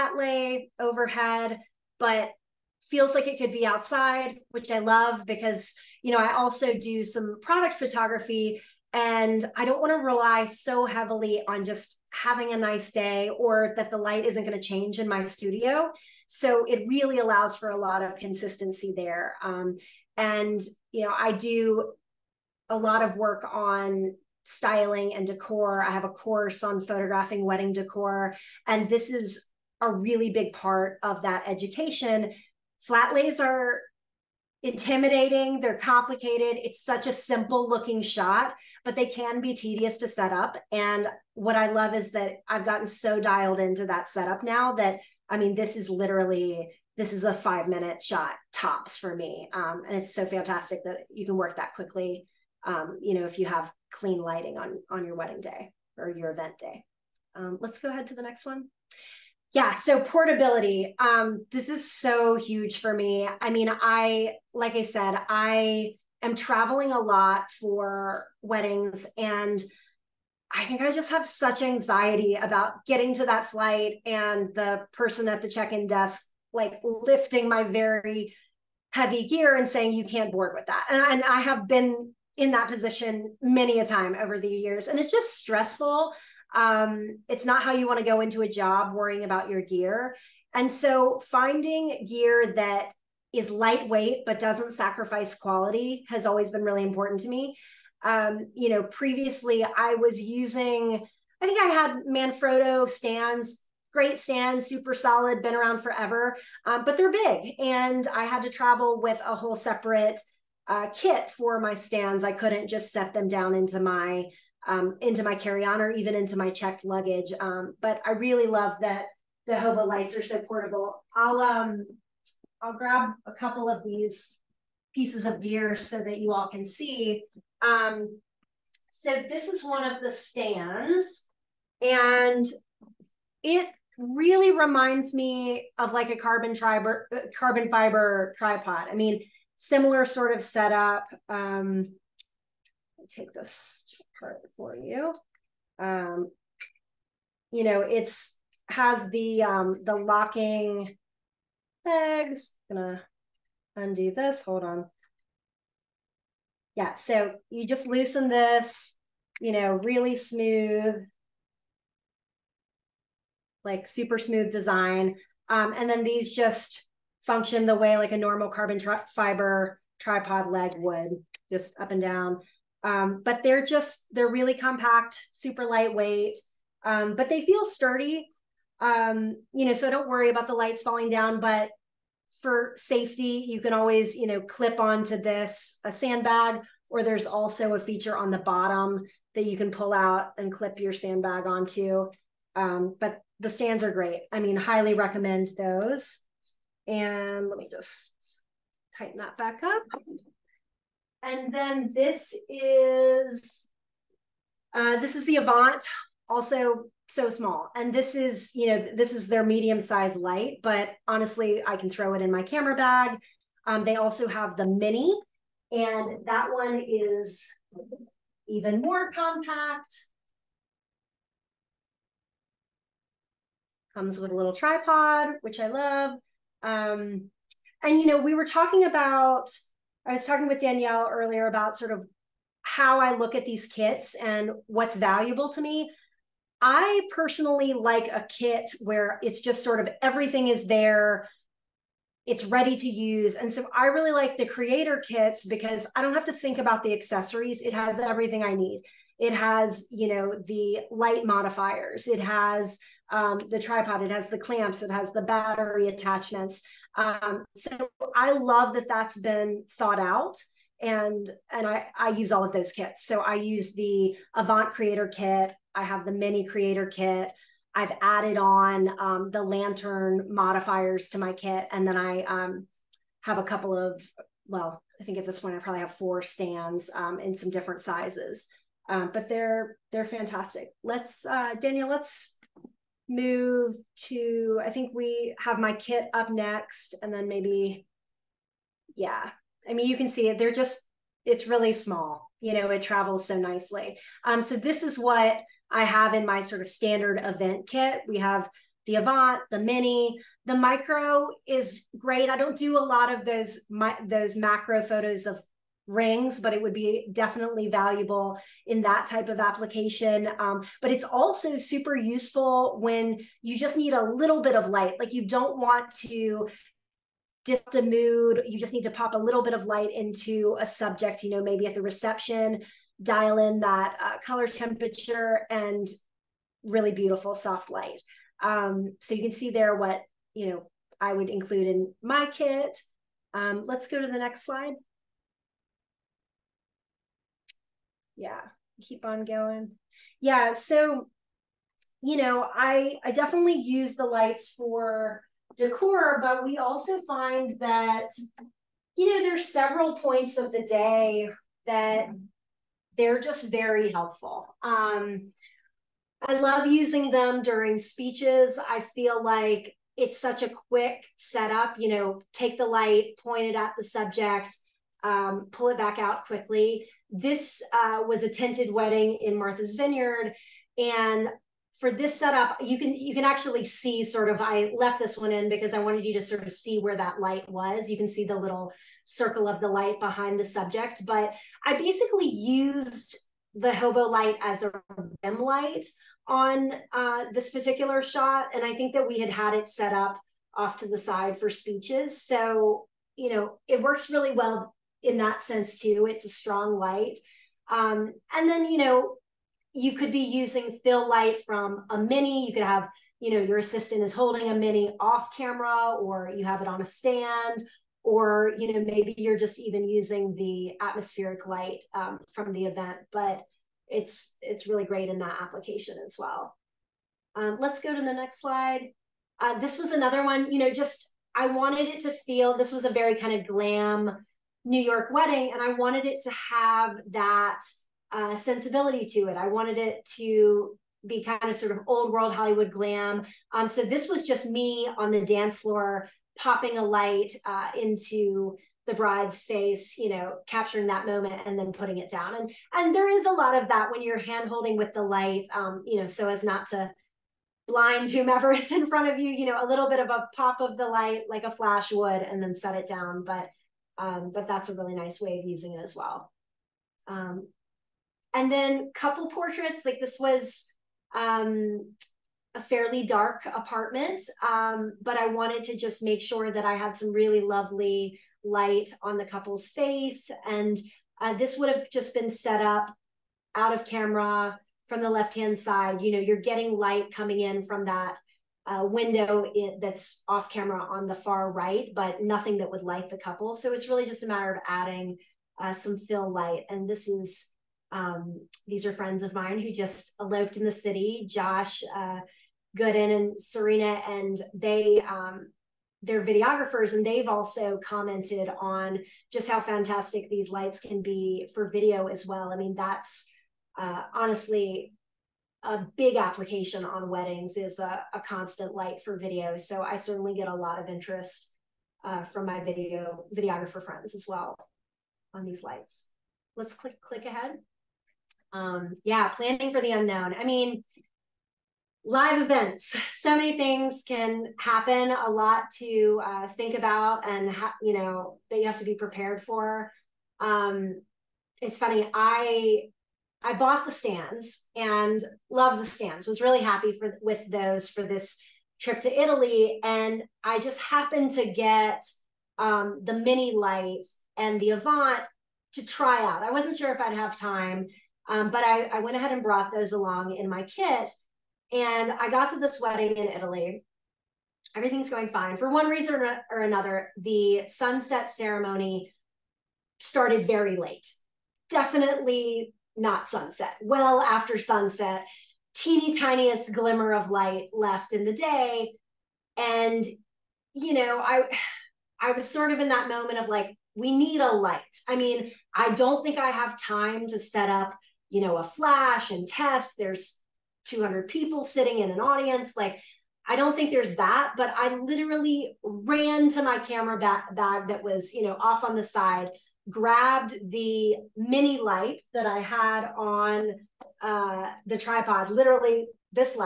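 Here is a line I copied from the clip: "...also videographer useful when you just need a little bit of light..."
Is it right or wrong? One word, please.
wrong.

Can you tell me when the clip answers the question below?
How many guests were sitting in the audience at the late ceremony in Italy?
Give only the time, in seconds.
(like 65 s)
580 s.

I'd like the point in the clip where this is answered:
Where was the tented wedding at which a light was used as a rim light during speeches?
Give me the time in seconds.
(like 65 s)
369 s.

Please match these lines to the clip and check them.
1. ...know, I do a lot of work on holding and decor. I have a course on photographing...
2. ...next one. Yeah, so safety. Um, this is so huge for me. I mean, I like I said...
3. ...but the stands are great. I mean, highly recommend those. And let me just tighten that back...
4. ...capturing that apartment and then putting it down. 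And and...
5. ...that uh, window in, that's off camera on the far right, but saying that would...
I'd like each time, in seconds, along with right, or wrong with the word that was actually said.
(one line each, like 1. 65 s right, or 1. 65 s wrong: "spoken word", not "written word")
1. 21 s wrong: "styling", not "holding"
2. 58 s wrong: "portability", not "safety"
3. 192 s right
4. 440 s wrong: "moment", not "apartment"
5. 477 s wrong: "nothing", not "saying".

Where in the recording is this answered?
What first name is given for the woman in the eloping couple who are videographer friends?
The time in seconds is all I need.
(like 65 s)
493 s.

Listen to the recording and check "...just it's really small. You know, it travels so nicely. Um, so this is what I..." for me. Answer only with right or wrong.
right.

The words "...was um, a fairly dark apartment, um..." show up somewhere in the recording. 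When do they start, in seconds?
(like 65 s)
460 s.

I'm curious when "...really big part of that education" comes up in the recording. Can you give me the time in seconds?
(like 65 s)
29 s.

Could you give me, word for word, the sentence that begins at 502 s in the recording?
I mean, that's uh, honestly a big application on weddings is a, a constant light for video.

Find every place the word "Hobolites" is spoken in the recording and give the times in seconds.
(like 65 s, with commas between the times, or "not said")
119 s, 383 s.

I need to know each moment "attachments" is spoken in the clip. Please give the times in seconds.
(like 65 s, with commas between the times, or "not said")
255 s.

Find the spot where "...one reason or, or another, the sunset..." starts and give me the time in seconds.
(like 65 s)
555 s.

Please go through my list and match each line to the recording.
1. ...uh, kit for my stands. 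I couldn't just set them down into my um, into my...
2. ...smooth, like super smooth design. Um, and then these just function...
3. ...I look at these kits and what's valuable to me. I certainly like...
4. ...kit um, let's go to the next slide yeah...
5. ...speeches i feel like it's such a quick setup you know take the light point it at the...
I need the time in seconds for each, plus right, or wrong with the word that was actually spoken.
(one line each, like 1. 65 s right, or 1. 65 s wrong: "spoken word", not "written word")
1. 110 s right
2. 160 s right
3. 232 s wrong: "personally", not "certainly"
4. 332 s right
5. 357 s right.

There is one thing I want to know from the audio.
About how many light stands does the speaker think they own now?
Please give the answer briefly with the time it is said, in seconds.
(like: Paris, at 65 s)
4, at 275 s.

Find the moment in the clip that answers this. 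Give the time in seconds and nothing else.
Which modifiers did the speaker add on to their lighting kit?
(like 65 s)
269 s.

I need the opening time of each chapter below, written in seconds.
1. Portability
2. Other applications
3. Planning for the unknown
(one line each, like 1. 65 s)
1. 58 s
2. 338 s
3. 519 s.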